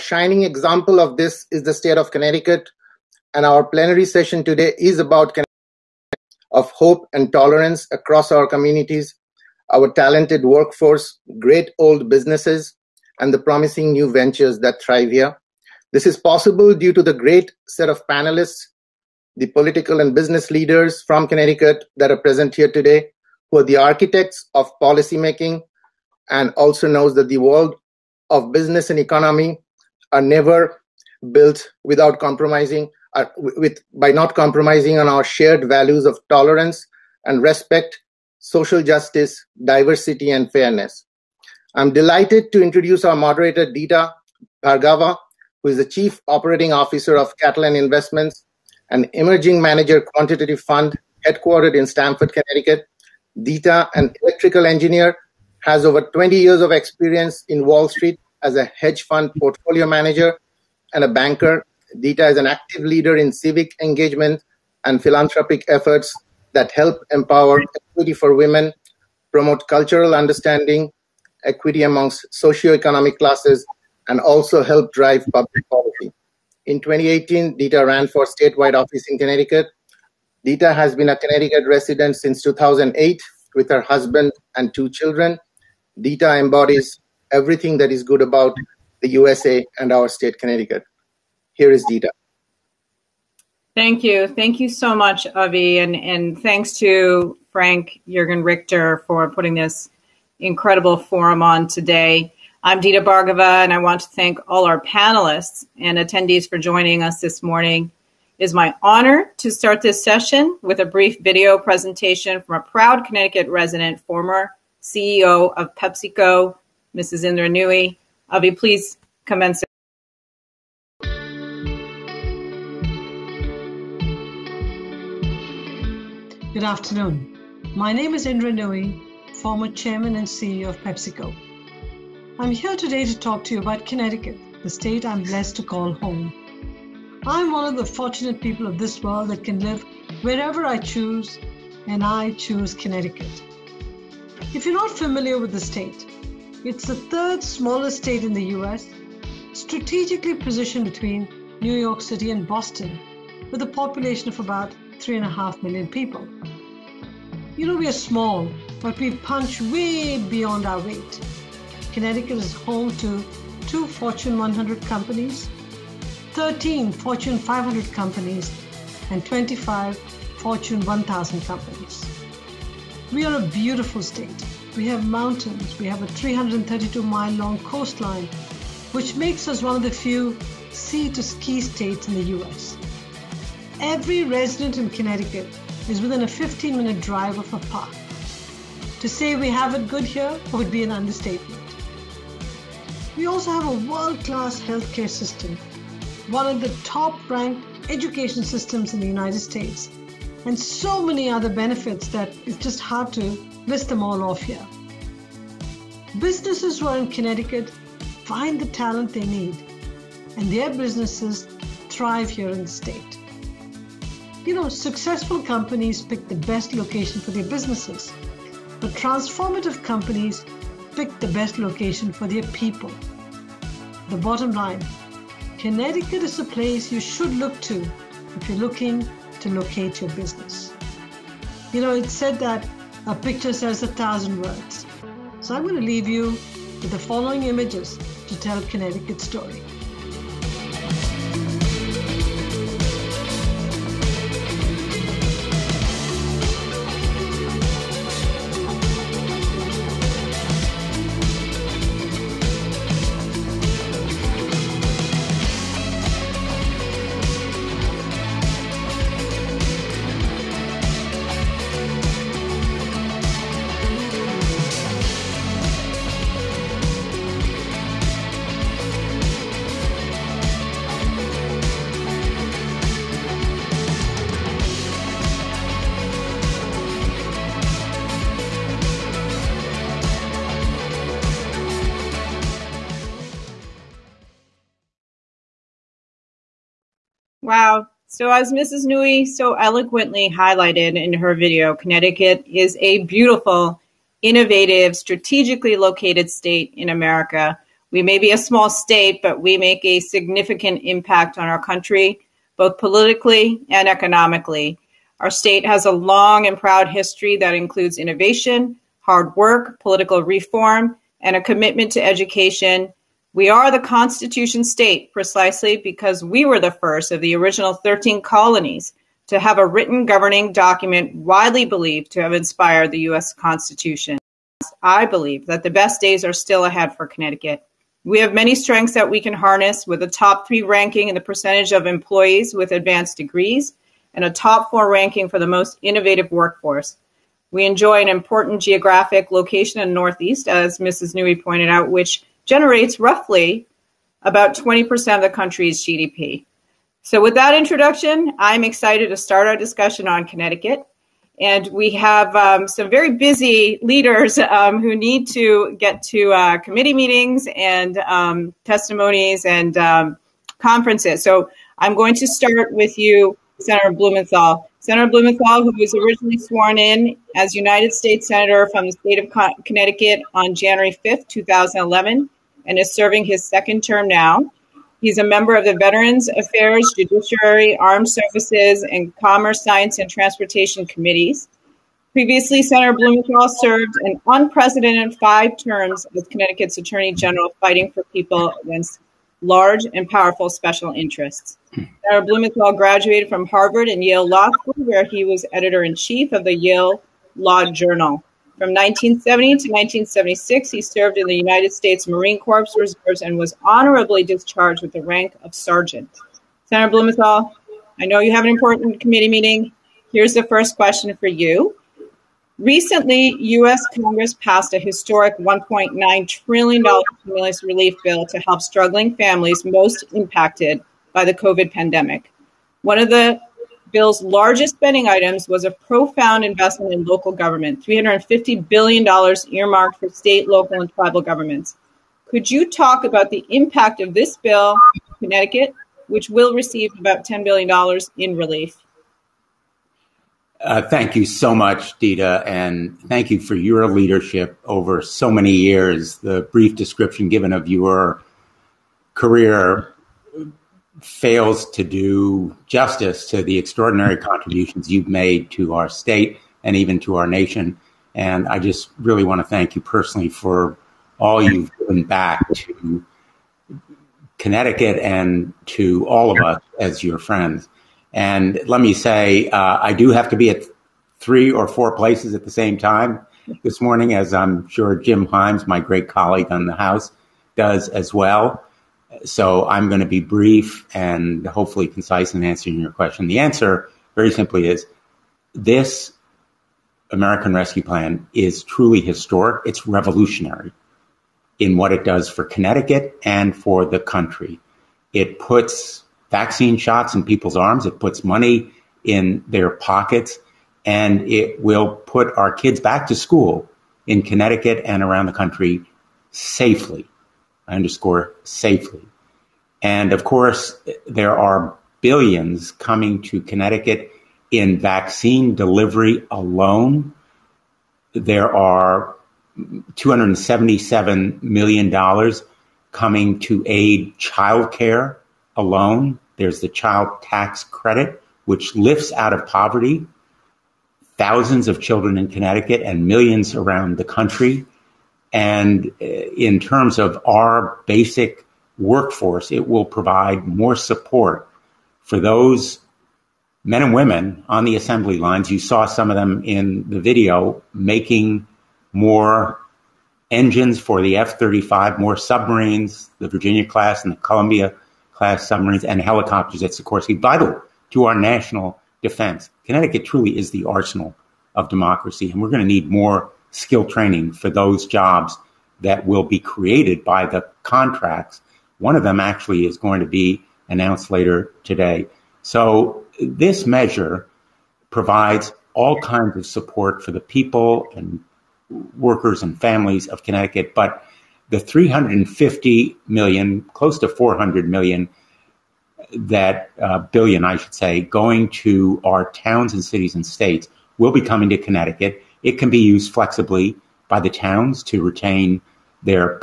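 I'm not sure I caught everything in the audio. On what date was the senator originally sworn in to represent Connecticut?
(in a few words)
January 5th, 2011.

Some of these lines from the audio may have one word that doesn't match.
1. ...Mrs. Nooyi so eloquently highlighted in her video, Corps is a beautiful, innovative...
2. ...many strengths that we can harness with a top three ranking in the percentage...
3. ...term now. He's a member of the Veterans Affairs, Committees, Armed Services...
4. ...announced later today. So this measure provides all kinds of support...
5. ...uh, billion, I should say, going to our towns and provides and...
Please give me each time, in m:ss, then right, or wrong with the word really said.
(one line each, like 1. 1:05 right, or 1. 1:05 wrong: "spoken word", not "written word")
1. 4:48 wrong: "Connecticut", not "Corps"
2. 5:28 right
3. 6:13 wrong: "Judiciary", not "Committees"
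4. 9:30 right
5. 9:46 wrong: "cities", not "provides".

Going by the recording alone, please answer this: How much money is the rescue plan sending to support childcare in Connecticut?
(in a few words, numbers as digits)
$277 million.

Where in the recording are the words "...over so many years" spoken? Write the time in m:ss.
7:24.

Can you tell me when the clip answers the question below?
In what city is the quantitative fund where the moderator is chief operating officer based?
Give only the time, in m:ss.
0:51.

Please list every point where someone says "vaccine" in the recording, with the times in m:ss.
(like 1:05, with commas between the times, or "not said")
8:16, 8:34.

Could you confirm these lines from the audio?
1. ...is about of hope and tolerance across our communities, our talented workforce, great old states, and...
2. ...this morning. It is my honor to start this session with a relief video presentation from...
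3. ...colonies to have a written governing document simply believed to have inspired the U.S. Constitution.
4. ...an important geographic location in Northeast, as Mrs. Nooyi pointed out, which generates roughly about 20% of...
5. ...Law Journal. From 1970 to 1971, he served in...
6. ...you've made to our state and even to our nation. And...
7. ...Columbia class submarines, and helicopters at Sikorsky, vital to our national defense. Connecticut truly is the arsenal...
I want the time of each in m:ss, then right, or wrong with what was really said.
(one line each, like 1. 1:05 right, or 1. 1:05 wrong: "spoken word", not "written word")
1. 0:04 wrong: "businesses", not "states"
2. 1:47 wrong: "brief", not "relief"
3. 5:18 wrong: "widely", not "simply"
4. 5:38 right
5. 6:37 wrong: "1976", not "1971"
6. 7:34 right
7. 9:14 right.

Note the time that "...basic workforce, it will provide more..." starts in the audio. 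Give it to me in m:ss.
8:57.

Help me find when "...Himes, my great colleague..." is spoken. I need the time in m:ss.
7:55.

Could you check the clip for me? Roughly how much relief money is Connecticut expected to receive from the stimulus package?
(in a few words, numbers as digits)
$10 billion.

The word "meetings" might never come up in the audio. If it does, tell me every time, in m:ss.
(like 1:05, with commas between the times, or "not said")
5:56, 6:49.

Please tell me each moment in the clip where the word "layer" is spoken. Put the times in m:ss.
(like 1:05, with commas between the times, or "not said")
not said.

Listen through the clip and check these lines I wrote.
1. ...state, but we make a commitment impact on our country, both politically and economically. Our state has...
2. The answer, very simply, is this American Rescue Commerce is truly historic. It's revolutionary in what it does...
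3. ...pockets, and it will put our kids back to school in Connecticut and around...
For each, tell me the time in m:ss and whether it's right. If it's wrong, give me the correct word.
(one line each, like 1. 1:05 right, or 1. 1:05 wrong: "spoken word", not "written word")
1. 4:58 wrong: "significant", not "commitment"
2. 8:03 wrong: "Plan", not "Commerce"
3. 8:19 right.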